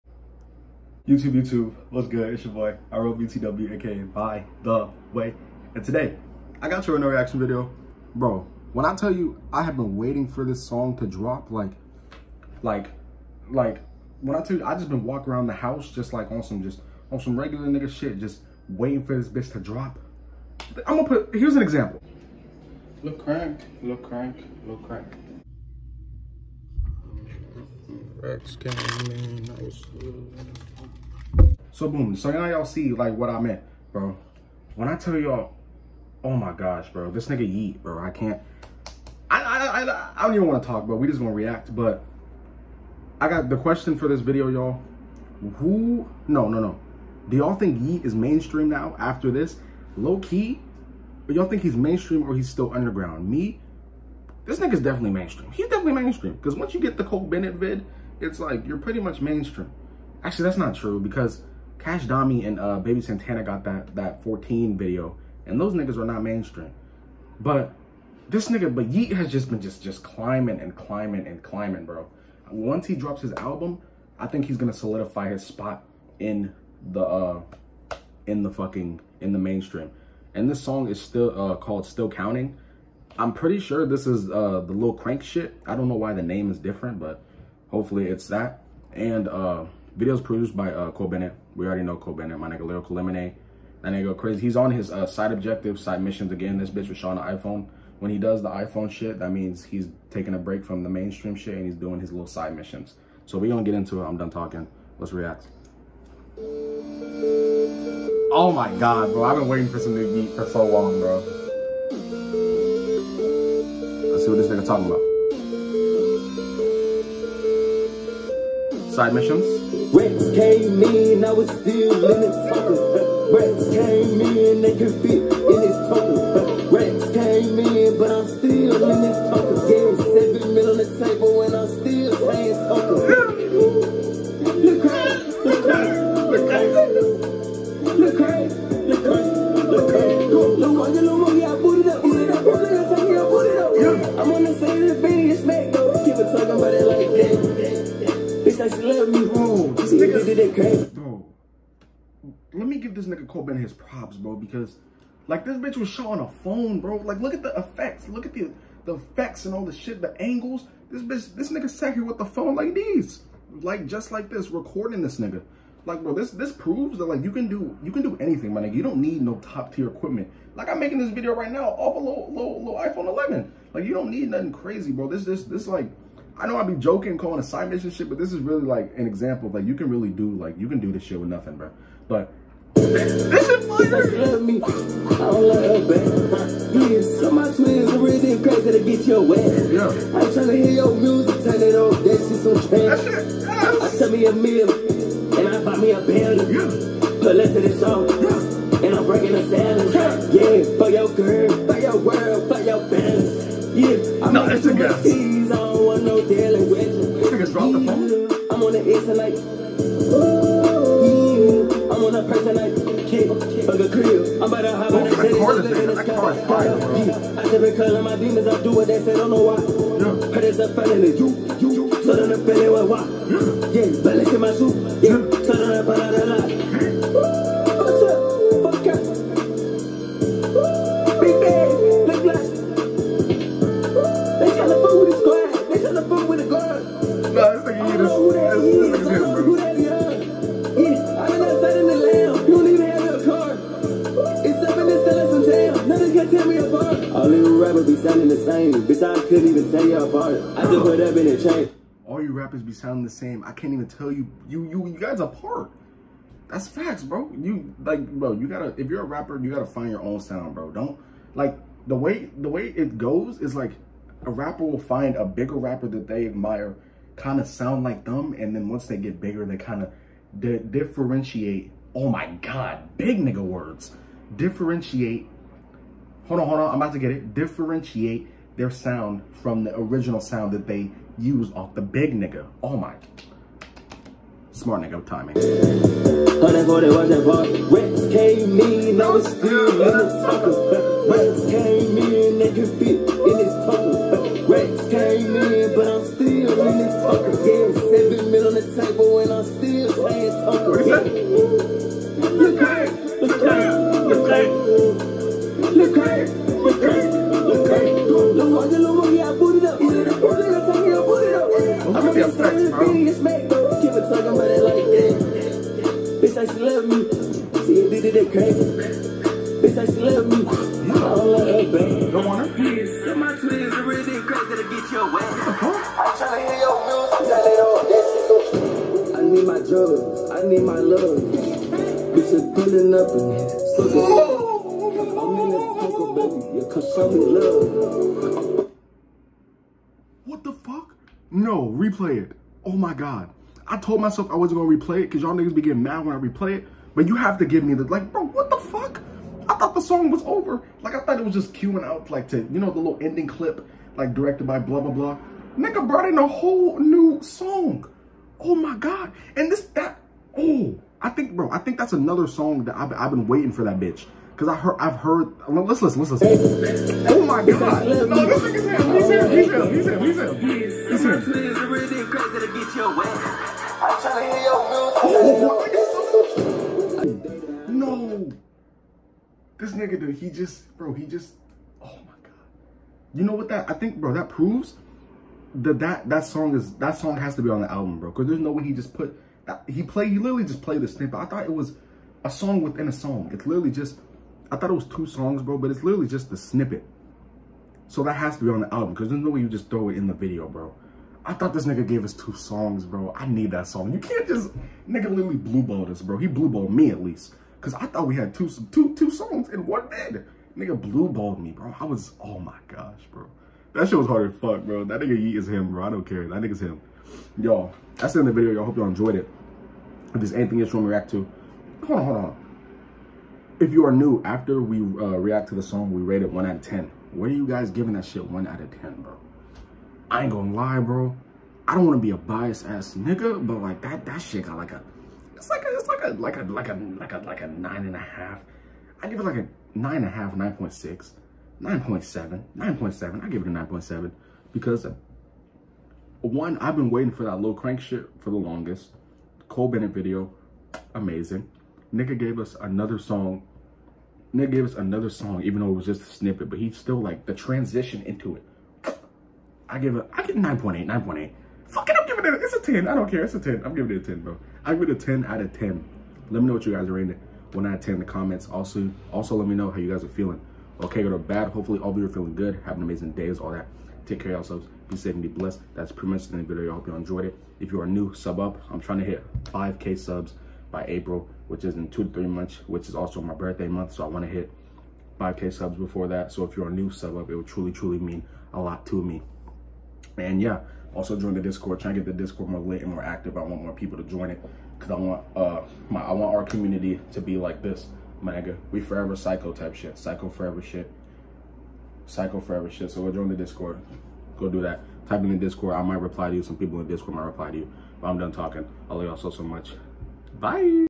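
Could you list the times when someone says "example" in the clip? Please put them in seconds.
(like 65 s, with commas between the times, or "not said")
21 s, 179 s.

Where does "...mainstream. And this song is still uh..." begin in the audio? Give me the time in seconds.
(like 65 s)
79 s.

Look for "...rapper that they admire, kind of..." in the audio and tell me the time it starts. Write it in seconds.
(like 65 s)
265 s.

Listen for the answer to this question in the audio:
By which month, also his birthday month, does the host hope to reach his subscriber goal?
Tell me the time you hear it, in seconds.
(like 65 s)
480 s.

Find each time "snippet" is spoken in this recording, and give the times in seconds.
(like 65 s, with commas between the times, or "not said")
390 s, 396 s, 456 s.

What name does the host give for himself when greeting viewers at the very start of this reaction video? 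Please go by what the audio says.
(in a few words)
ROBTW.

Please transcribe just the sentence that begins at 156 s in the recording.
Like look at the effects, look at the the effects and all the shit, the angles.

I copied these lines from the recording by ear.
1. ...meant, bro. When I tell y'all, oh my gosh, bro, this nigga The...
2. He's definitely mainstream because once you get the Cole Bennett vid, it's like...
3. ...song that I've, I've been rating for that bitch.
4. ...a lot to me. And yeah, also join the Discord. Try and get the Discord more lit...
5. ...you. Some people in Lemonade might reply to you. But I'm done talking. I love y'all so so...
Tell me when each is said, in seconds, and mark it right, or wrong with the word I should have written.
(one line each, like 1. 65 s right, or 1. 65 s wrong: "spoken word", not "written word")
1. 33 s wrong: "Yeat", not "The"
2. 55 s right
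3. 362 s wrong: "waiting", not "rating"
4. 488 s right
5. 506 s wrong: "Discord", not "Lemonade".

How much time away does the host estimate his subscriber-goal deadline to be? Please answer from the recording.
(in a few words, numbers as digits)
2 to 3 months.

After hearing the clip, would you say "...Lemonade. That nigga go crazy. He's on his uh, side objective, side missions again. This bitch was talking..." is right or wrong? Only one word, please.
wrong.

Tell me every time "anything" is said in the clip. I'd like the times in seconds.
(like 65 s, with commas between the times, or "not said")
168 s, 420 s.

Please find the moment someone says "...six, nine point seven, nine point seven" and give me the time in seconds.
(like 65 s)
440 s.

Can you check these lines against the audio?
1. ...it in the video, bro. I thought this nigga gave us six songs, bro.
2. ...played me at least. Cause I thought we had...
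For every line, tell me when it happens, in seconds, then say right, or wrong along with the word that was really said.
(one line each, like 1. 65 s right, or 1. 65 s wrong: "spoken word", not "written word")
1. 399 s wrong: "two", not "six"
2. 406 s wrong: "blueballed", not "played".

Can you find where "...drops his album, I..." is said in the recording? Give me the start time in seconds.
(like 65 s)
72 s.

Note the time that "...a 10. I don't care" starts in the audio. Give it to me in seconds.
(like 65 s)
462 s.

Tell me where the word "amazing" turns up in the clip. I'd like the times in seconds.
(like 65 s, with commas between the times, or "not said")
450 s, 472 s.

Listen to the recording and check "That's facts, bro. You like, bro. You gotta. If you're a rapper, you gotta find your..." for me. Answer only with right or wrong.
right.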